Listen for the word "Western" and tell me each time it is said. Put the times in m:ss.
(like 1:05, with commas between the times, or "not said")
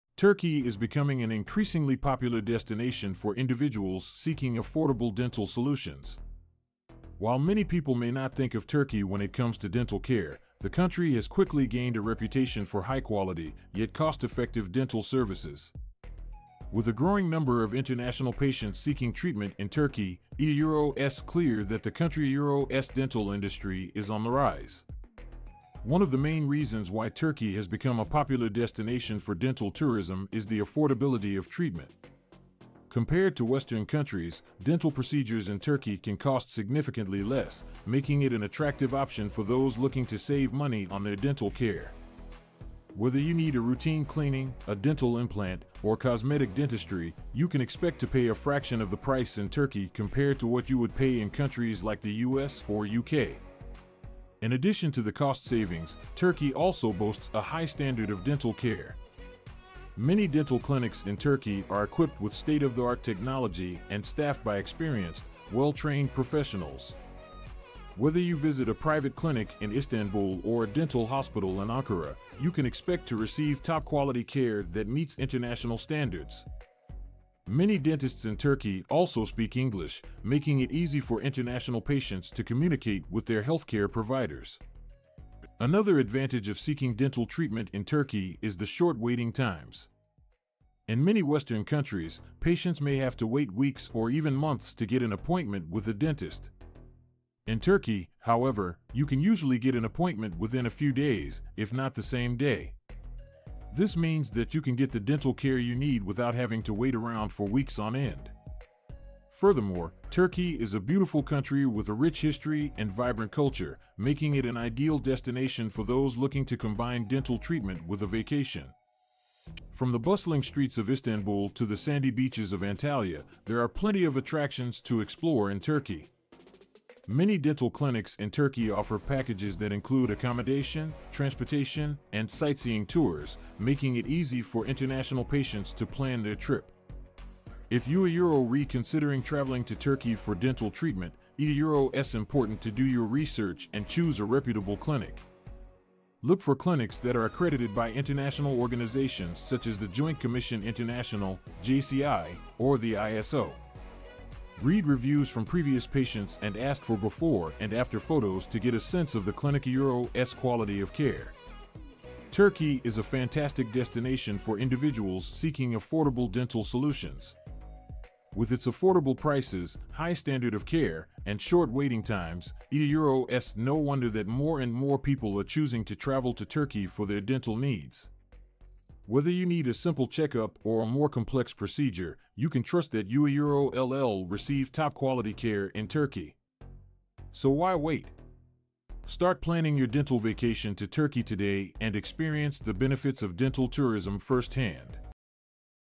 0:33, 1:31.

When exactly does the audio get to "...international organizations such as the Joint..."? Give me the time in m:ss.
2:27.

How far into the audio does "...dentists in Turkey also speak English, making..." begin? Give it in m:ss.
1:17.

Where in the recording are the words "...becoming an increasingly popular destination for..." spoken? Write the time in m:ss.
0:00.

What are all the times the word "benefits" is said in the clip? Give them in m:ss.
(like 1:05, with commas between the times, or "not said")
3:12.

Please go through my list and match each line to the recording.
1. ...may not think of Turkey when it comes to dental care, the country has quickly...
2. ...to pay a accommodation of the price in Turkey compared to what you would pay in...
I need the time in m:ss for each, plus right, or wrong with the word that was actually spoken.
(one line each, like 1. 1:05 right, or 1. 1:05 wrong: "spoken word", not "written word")
1. 0:07 right
2. 0:48 wrong: "fraction", not "accommodation".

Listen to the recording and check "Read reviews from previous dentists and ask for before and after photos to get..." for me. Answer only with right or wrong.
wrong.